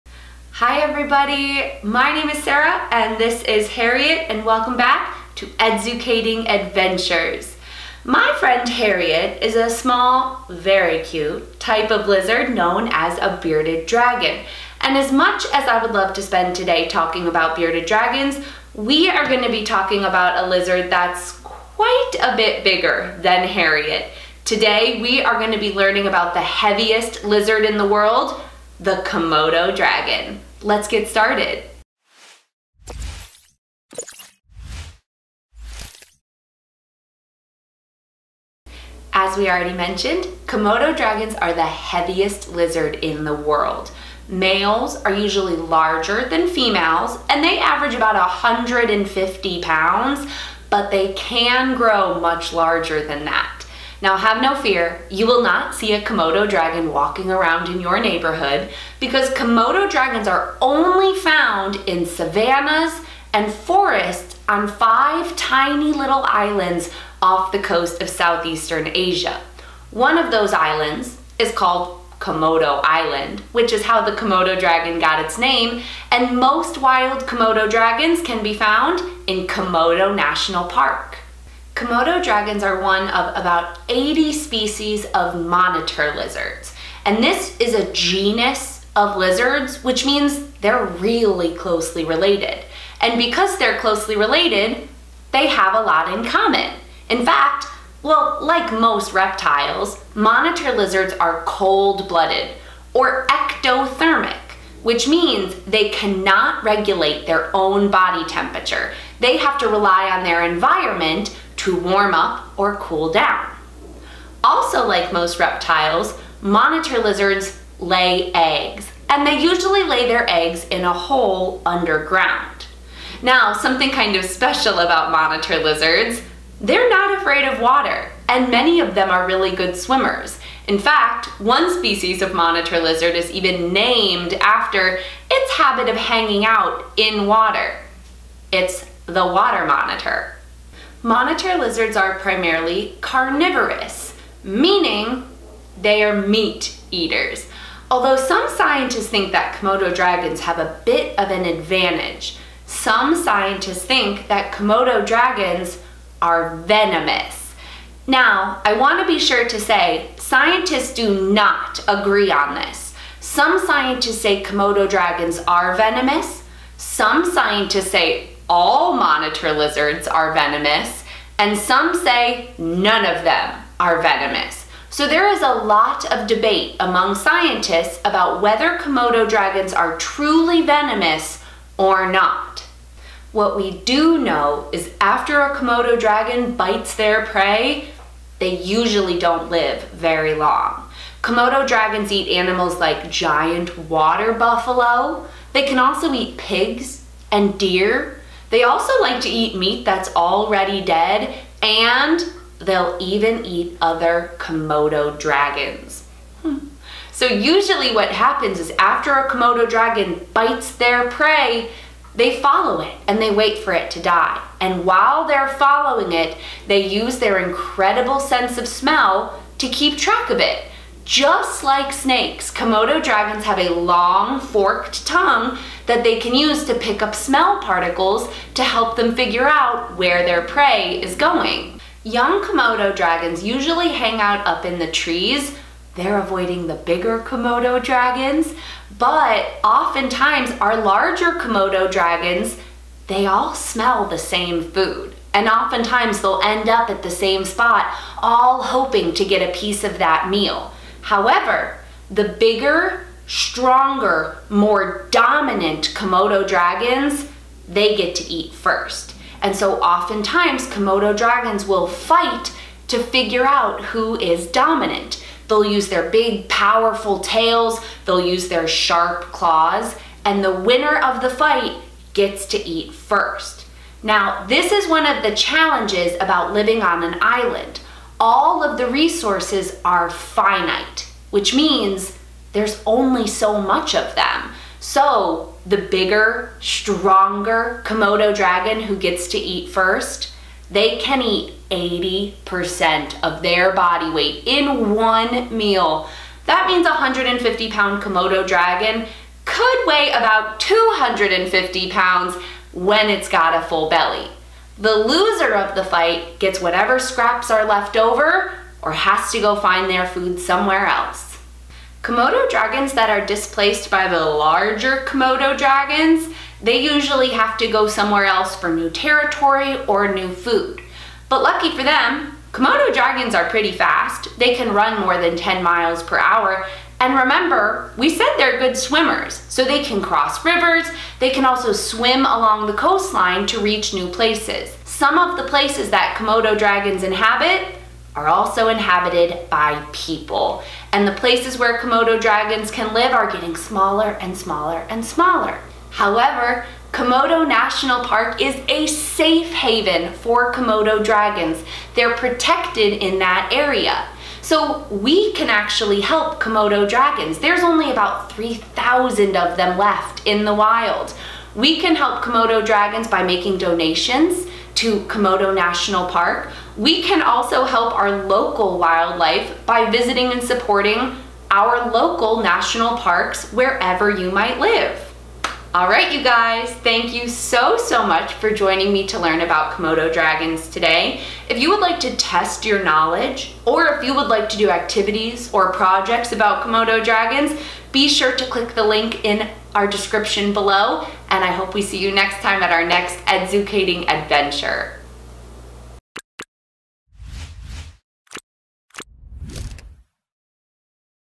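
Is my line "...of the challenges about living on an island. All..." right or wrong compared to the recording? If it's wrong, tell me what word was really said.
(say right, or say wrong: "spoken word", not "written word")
right.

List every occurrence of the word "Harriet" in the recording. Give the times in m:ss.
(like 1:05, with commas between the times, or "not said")
0:03, 0:08, 0:23.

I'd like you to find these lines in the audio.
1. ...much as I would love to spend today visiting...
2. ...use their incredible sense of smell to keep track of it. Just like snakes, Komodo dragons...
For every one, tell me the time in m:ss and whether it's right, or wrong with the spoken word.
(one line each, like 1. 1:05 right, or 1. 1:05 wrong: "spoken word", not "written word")
1. 0:15 wrong: "talking", not "visiting"
2. 3:36 right.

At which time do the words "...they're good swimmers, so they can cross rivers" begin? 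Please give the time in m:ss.
5:28.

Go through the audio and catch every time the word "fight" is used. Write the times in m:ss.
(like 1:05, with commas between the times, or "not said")
4:21, 4:31, 5:05.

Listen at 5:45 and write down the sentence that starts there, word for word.
However, Komodo National Park is a safe haven for Komodo dragons.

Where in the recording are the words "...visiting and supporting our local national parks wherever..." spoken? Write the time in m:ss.
6:09.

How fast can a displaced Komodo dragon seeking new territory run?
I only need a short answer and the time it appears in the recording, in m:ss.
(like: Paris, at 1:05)
more than 10 miles per hour, at 5:24.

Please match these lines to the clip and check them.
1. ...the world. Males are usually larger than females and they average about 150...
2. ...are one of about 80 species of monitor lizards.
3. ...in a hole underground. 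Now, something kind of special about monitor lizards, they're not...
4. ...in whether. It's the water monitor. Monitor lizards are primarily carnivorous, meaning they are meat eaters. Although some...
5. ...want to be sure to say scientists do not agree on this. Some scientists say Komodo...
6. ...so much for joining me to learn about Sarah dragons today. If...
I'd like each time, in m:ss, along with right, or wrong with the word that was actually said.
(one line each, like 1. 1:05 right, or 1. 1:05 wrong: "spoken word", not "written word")
1. 0:43 right
2. 1:22 right
3. 2:00 right
4. 2:16 wrong: "water", not "whether"
5. 2:38 right
6. 6:17 wrong: "Komodo", not "Sarah".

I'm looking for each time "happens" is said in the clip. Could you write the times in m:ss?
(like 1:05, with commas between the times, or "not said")
3:28.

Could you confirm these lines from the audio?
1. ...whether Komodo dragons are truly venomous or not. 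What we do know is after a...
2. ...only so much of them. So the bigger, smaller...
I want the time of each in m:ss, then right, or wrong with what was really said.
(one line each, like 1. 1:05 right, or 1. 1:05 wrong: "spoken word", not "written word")
1. 2:58 right
2. 4:42 wrong: "stronger", not "smaller".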